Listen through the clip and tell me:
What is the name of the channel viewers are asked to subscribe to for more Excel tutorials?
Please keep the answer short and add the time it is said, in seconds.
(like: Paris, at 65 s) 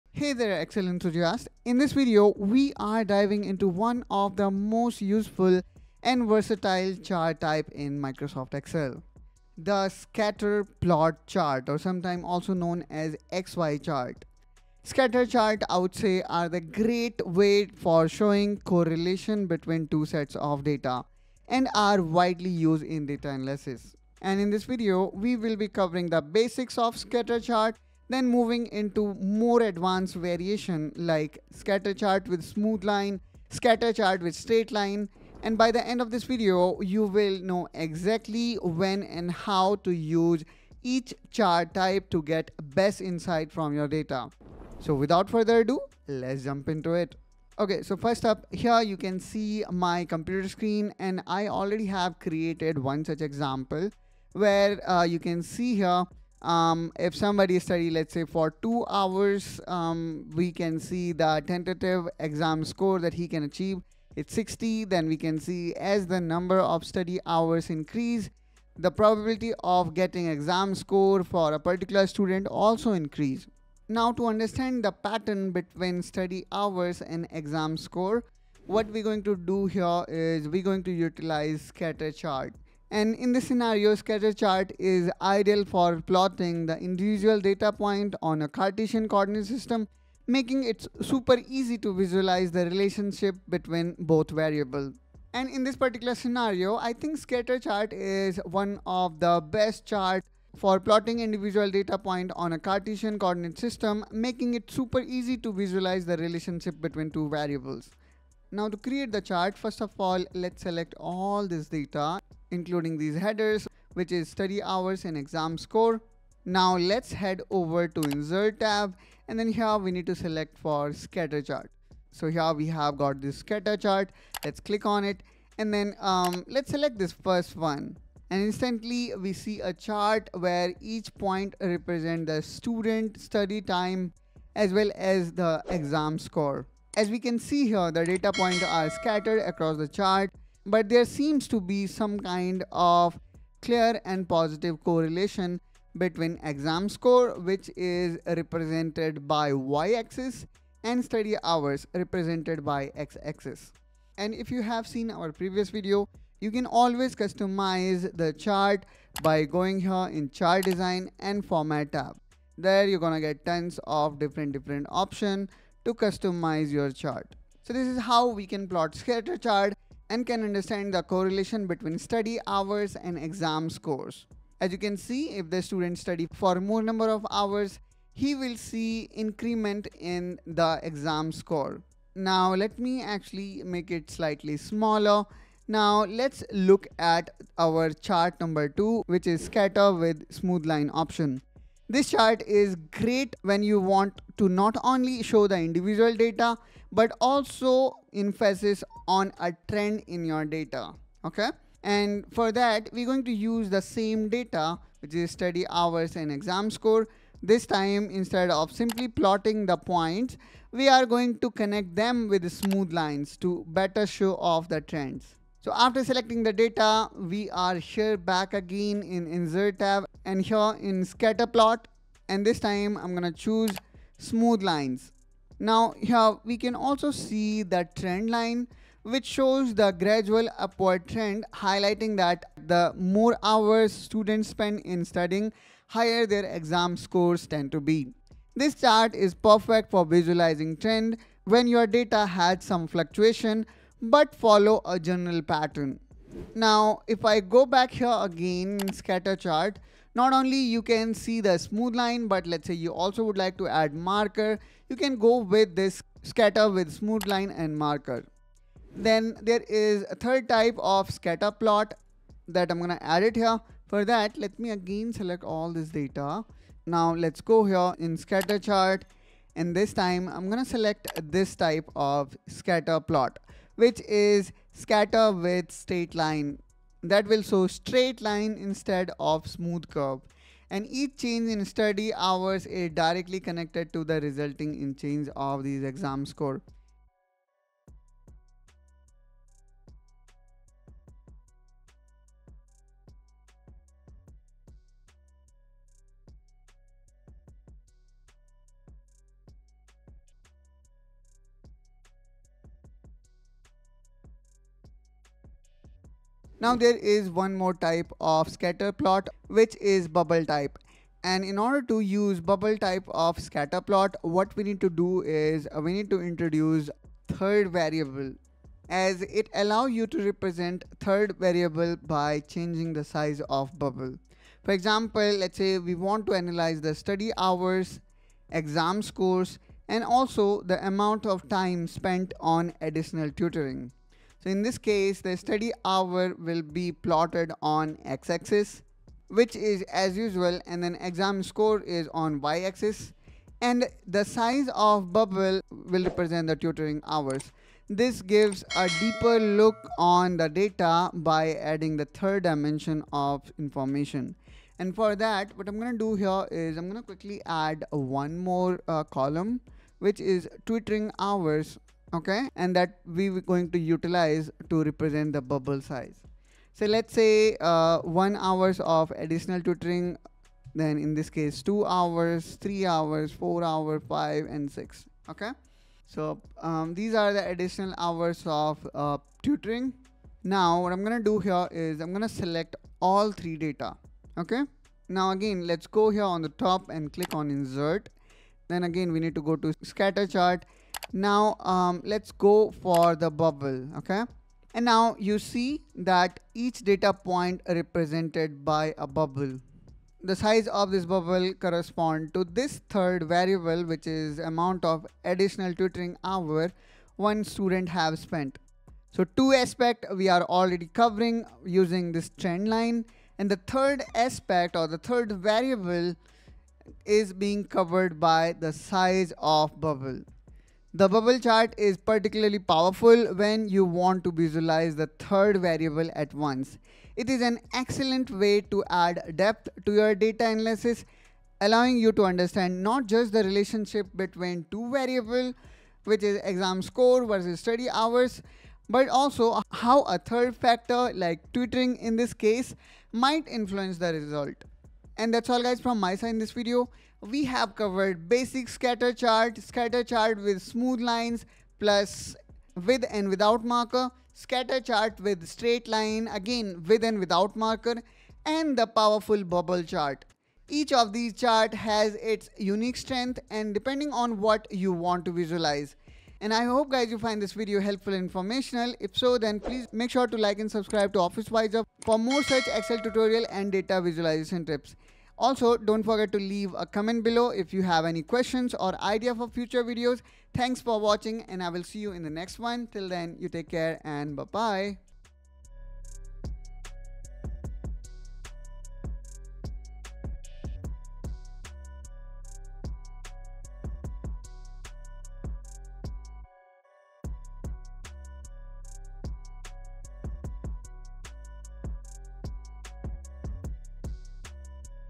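OfficeWiser, at 471 s.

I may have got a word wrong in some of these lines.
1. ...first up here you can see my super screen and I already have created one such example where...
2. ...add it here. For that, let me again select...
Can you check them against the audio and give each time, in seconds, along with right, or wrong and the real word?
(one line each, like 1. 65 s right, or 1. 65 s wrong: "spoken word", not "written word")
1. 47 s wrong: "computer", not "super"
2. 263 s right.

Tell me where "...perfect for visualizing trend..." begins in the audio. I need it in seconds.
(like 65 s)
239 s.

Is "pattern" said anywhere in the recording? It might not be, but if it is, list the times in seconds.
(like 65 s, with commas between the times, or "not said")
74 s, 245 s.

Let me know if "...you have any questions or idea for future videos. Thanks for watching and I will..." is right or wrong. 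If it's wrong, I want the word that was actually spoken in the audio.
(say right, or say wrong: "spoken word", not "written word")
right.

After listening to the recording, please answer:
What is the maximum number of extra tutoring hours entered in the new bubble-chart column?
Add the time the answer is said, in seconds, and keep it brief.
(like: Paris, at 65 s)
6, at 374 s.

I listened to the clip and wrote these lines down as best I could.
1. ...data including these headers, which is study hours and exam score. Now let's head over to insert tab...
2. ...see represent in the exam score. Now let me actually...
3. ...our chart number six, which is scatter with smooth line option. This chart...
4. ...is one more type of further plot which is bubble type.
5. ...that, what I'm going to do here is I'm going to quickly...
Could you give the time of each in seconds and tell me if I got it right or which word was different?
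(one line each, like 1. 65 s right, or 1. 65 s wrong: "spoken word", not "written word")
1. 111 s right
2. 178 s wrong: "increment", not "represent"
3. 187 s wrong: "two", not "six"
4. 306 s wrong: "scatter", not "further"
5. 355 s right.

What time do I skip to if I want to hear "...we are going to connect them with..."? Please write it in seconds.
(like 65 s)
210 s.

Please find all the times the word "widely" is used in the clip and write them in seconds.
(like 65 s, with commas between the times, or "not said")
22 s.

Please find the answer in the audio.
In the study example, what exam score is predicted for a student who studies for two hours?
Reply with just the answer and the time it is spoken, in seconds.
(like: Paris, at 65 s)
60, at 64 s.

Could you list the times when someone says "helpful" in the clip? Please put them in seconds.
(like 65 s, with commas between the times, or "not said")
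467 s.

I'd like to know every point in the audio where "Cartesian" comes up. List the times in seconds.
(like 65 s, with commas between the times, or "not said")
88 s, 102 s.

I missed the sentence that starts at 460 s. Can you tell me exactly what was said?
Each of these chart has its unique strength and depending on what you want to visualize.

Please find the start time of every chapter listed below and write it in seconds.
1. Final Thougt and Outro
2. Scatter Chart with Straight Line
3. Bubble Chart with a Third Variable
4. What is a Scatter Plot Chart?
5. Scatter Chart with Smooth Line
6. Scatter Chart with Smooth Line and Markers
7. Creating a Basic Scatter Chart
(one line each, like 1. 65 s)
1. 445 s
2. 258 s
3. 306 s
4. 15 s
5. 189 s
6. 246 s
7. 108 s.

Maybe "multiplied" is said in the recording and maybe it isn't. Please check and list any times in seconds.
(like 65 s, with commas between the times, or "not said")
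not said.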